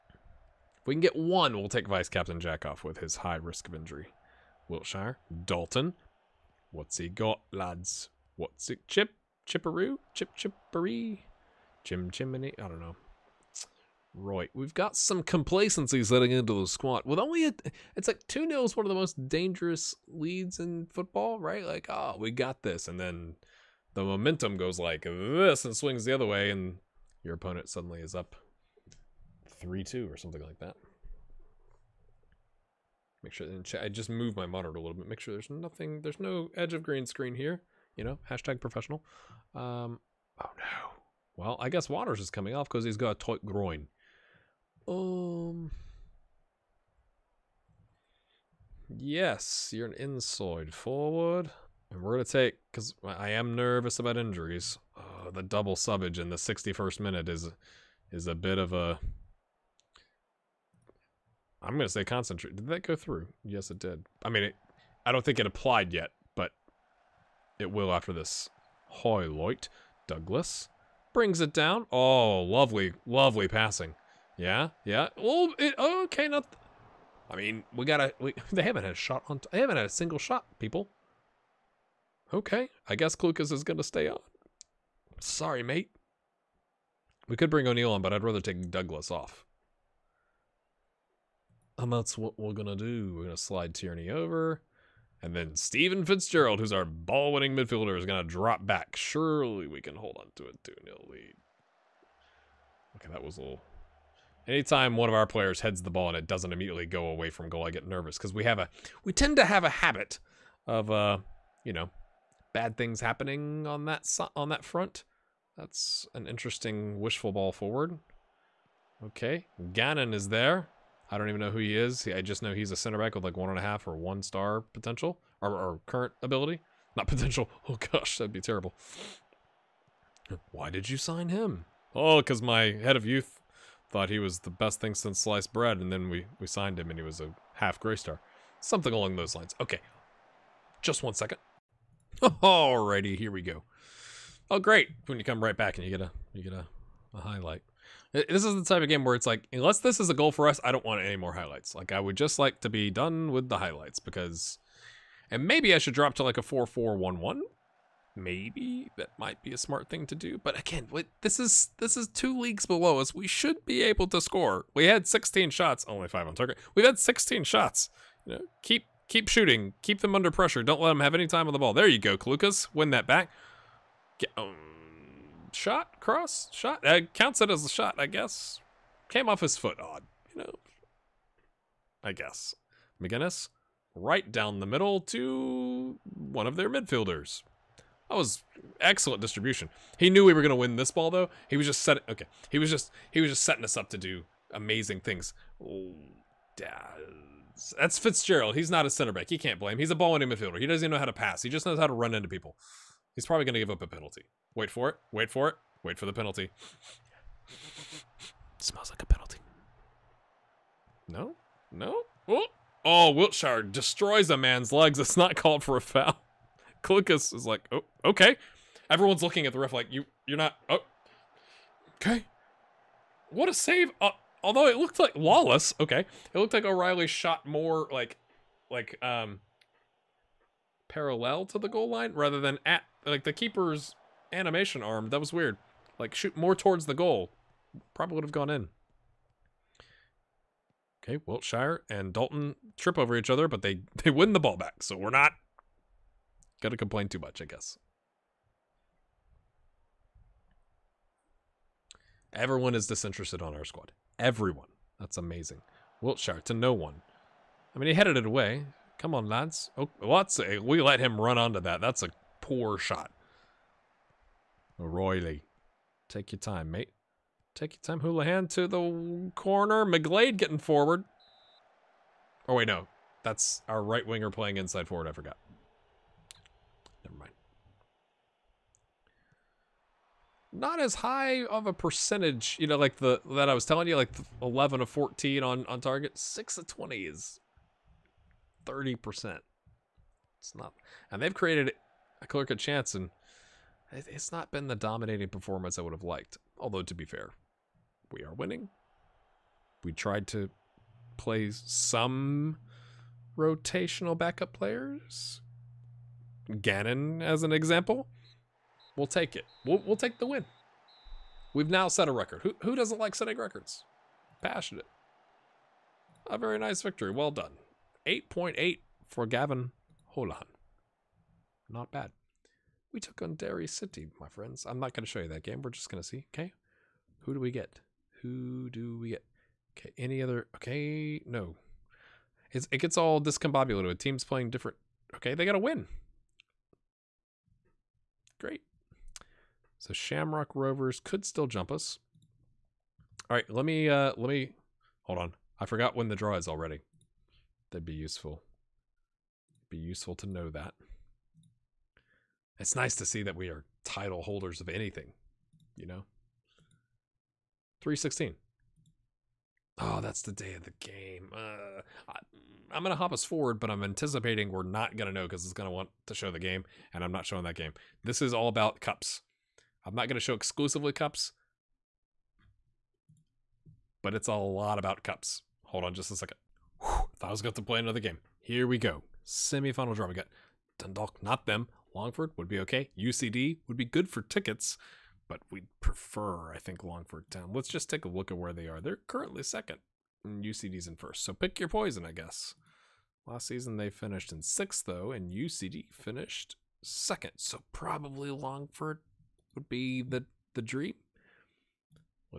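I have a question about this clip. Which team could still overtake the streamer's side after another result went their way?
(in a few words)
Shamrock Rovers.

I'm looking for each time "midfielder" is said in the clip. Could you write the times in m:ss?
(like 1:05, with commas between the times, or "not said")
1:37, 3:06, 3:20.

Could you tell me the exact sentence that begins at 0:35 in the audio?
Make sure there's nothing, there's no edge of green screen here.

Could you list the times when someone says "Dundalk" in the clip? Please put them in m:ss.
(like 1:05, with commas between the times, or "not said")
6:20.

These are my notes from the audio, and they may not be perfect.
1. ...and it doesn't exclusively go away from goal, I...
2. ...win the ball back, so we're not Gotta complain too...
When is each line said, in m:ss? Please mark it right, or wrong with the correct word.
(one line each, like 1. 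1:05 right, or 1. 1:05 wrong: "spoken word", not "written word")
1. 1:46 wrong: "immediately", not "exclusively"
2. 4:04 right.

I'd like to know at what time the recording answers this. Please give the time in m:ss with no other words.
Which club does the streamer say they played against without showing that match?
5:23.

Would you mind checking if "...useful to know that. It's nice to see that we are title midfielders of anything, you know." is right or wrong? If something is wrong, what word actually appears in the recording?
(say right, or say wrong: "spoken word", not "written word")
wrong: "holders", not "midfielders".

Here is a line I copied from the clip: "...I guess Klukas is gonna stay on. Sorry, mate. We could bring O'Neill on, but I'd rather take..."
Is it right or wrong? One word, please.
right.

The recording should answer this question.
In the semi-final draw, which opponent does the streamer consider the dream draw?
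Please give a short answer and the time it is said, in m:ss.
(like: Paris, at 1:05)
Longford Town, at 6:26.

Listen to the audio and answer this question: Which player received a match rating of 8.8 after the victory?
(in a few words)
Gavin Holahan.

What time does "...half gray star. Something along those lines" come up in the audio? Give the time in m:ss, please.
2:17.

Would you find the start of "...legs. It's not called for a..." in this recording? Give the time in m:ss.
3:34.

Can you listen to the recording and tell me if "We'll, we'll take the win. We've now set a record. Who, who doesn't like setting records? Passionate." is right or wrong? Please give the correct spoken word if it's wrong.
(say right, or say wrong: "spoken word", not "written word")
right.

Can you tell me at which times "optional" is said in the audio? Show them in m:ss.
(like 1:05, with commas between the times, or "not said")
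not said.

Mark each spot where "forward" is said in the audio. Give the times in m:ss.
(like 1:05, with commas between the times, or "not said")
0:50, 1:57, 4:30, 4:34, 6:03.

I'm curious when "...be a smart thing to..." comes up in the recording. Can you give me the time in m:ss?
2:39.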